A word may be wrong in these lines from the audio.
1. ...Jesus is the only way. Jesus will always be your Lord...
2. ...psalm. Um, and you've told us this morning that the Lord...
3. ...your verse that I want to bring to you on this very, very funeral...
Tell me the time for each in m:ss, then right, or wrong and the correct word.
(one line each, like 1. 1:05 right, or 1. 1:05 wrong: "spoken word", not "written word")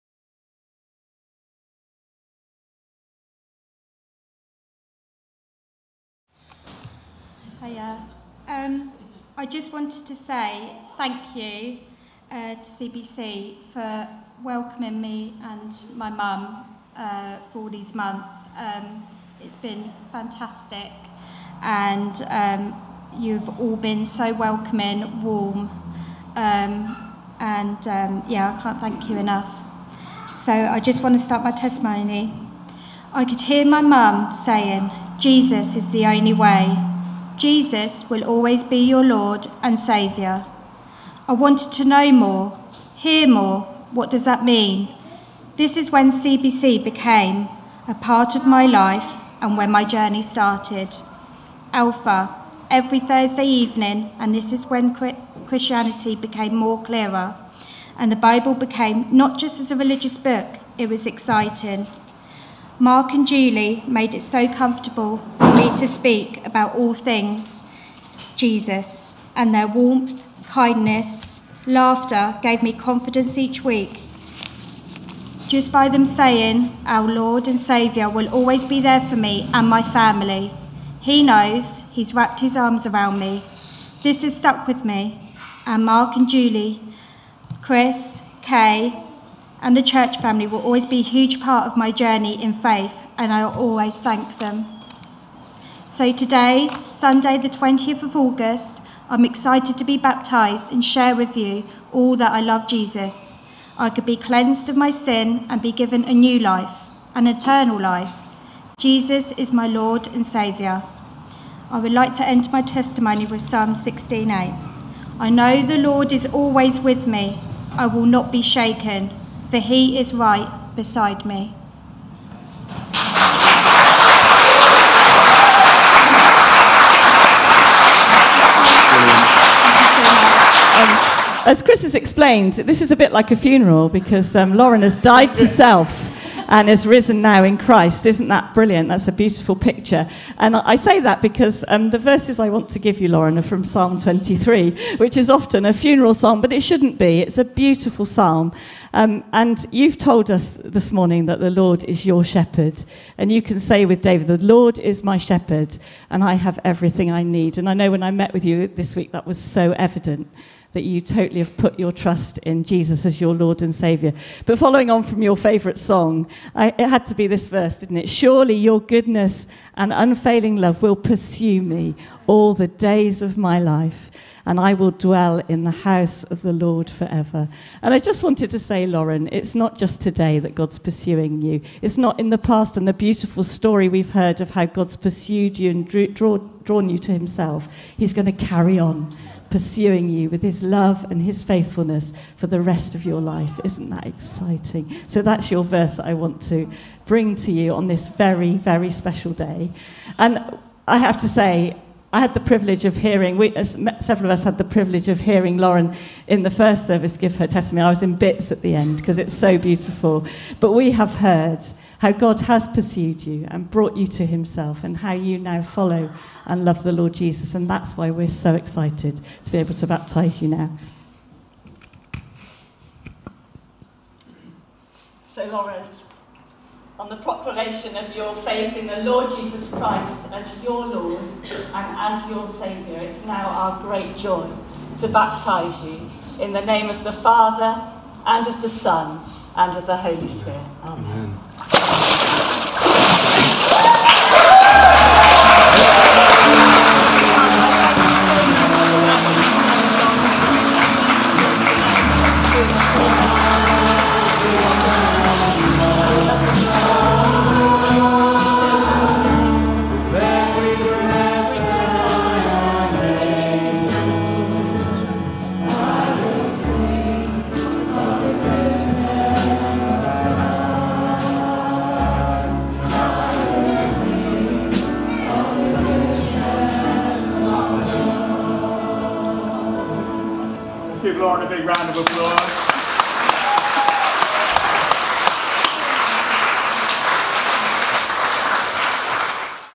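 1. 0:35 right
2. 2:28 right
3. 3:15 wrong: "special", not "funeral".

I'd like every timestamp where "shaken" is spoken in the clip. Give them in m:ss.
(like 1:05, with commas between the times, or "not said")
1:58.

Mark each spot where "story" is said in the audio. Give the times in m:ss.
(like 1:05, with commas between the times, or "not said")
3:03.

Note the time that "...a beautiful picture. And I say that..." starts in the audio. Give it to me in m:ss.
2:19.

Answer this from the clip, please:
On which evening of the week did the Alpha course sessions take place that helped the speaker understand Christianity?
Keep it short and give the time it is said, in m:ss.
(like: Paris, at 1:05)
Thursday, at 0:52.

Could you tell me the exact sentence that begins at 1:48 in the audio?
Jesus is my Lord and Saviour.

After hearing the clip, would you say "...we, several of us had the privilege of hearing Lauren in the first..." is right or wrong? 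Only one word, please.
right.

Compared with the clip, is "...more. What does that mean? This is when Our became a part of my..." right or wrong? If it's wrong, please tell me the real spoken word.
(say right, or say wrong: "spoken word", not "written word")
wrong: "CBC", not "Our".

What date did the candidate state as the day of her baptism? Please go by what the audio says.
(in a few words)
Sunday, 20th of August.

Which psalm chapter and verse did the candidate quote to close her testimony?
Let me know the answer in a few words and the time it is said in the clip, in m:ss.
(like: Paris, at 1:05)
Psalm 16:8, at 1:53.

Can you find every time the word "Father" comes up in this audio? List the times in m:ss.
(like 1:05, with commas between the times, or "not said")
3:57.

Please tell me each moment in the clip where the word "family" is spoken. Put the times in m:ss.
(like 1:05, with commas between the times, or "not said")
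1:19, 1:30.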